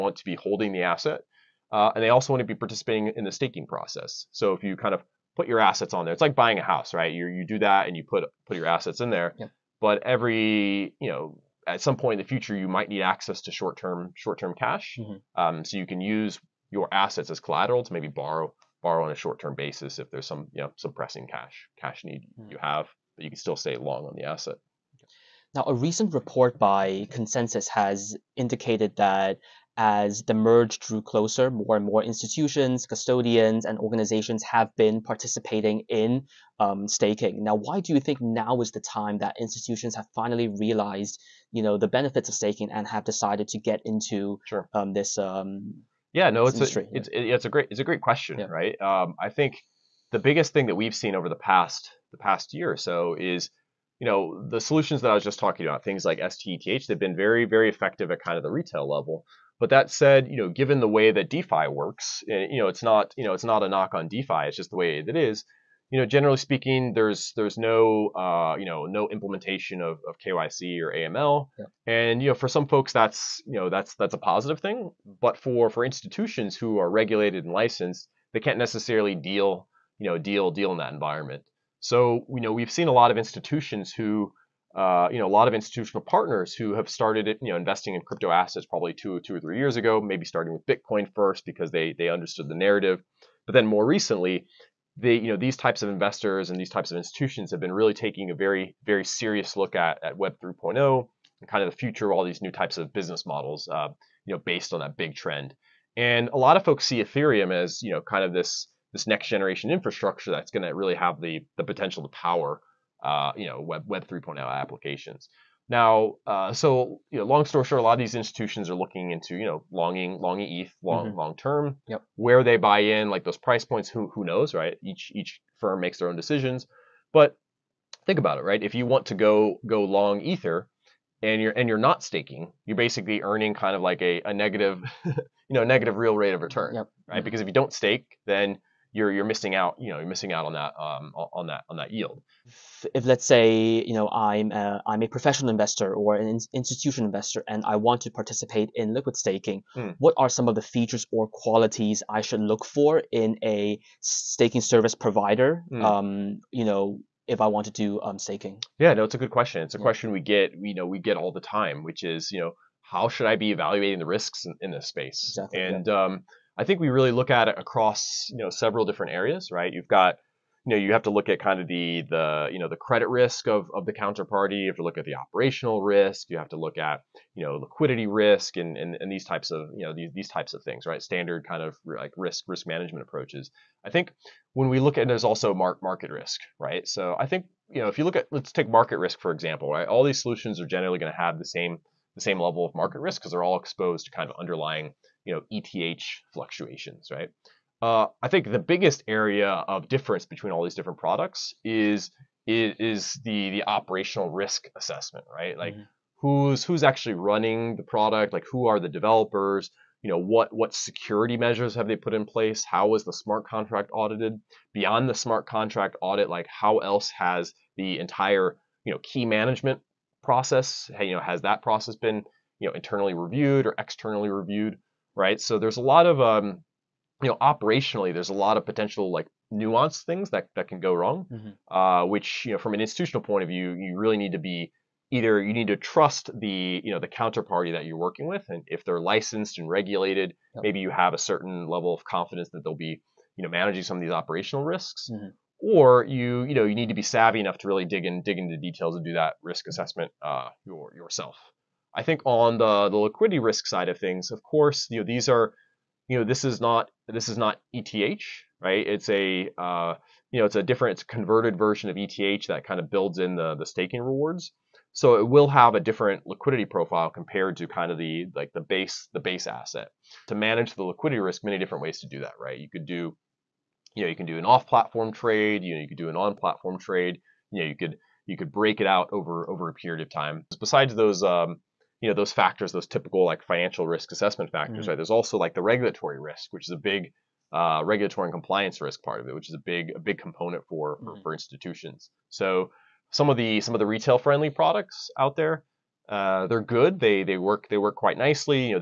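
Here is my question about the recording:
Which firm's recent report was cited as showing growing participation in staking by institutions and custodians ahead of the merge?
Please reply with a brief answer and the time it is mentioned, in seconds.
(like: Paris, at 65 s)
Consensus, at 27 s.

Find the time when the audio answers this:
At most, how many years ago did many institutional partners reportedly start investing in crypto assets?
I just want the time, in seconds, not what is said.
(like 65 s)
89 s.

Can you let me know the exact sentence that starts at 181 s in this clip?
Standard kind of like risk risk management approaches.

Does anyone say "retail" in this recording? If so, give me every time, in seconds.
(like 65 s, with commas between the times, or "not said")
58 s, 293 s.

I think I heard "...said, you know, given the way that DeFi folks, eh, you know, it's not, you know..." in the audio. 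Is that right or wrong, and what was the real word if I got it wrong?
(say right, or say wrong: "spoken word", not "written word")
wrong: "works", not "folks".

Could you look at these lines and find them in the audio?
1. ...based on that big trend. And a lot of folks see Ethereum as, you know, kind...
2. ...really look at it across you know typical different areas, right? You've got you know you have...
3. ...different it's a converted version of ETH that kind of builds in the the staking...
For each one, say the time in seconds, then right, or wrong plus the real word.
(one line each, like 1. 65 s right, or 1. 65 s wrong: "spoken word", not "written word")
1. 104 s right
2. 166 s wrong: "several", not "typical"
3. 260 s right.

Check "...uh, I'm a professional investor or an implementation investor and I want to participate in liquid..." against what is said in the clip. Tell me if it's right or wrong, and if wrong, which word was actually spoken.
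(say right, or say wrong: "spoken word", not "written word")
wrong: "institution", not "implementation".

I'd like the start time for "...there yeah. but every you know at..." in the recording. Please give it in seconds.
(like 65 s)
9 s.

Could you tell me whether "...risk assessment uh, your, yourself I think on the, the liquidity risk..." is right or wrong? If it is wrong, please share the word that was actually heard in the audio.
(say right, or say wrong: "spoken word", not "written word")
right.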